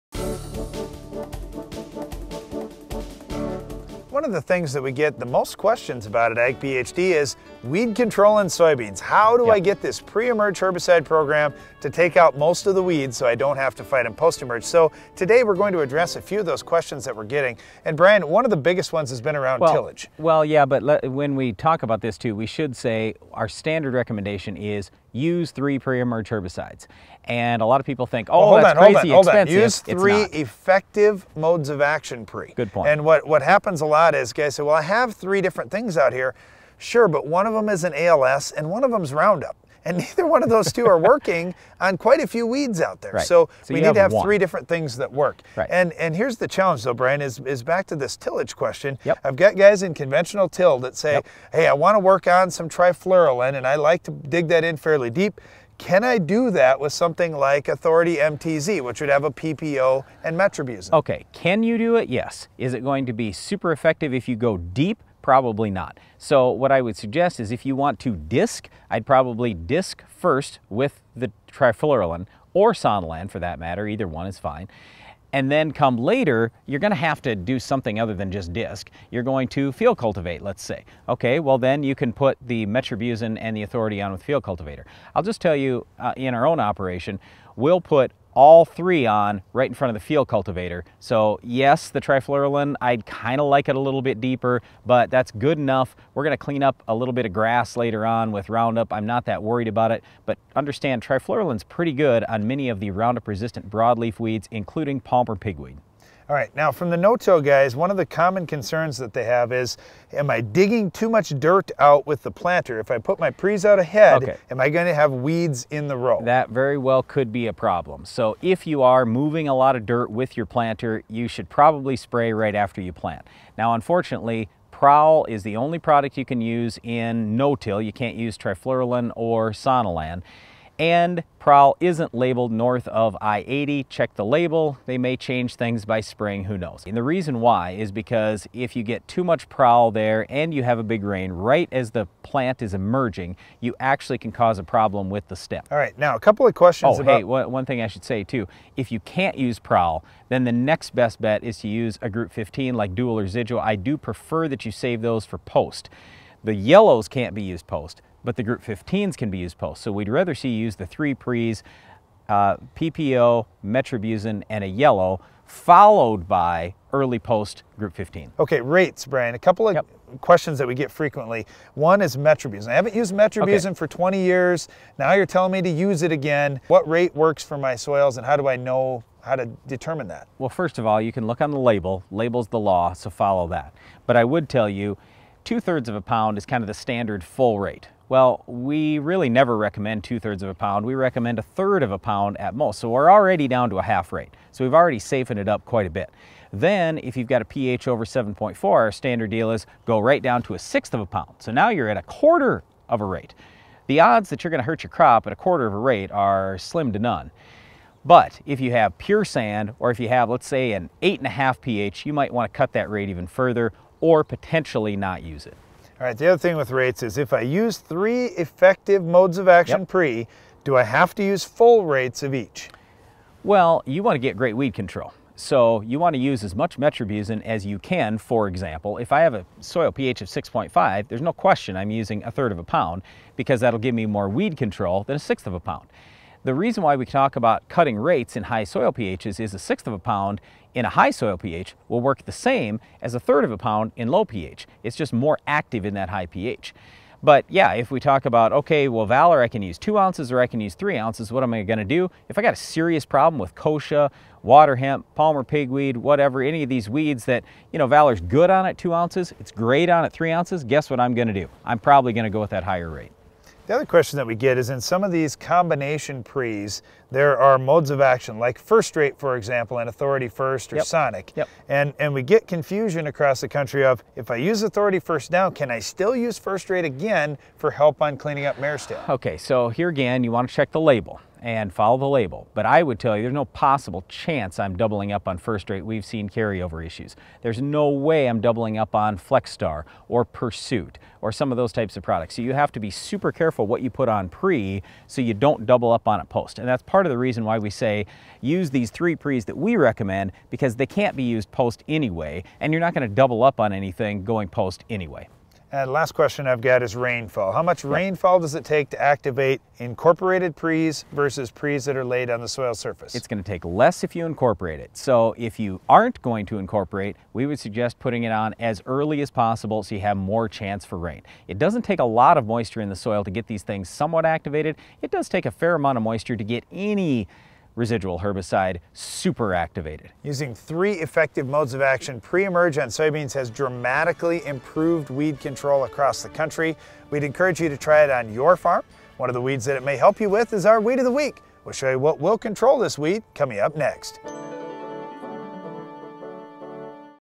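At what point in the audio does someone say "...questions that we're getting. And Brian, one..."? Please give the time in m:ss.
0:16.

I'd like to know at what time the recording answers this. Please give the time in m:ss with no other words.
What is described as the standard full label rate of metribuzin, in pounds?
3:05.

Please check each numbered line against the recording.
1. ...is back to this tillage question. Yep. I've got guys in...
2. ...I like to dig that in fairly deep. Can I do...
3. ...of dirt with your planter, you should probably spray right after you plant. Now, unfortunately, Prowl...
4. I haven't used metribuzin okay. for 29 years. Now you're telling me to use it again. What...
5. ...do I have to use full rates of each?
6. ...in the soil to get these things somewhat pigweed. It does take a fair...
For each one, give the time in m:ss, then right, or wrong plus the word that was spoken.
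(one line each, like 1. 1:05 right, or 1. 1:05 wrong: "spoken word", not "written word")
1. 0:47 right
2. 0:53 right
3. 1:59 right
4. 2:52 wrong: "20", not "29"
5. 3:40 right
6. 5:22 wrong: "activated", not "pigweed".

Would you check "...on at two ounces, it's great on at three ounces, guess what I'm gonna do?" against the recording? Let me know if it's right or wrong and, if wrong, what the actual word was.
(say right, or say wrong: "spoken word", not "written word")
right.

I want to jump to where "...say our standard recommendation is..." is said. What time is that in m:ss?
0:22.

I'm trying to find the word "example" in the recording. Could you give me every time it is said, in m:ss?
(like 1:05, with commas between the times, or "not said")
3:48, 4:29.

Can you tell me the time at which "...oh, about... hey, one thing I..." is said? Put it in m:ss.
2:26.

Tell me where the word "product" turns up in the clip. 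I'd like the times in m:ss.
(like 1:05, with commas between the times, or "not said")
2:05, 4:52.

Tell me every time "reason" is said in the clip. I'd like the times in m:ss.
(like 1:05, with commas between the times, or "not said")
2:17, 3:56, 4:57.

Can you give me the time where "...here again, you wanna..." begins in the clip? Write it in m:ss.
4:39.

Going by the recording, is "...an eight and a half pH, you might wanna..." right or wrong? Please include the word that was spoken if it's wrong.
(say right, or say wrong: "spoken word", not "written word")
right.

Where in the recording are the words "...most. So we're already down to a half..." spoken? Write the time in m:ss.
3:12.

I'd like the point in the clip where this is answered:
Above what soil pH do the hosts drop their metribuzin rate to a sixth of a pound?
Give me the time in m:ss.
3:18.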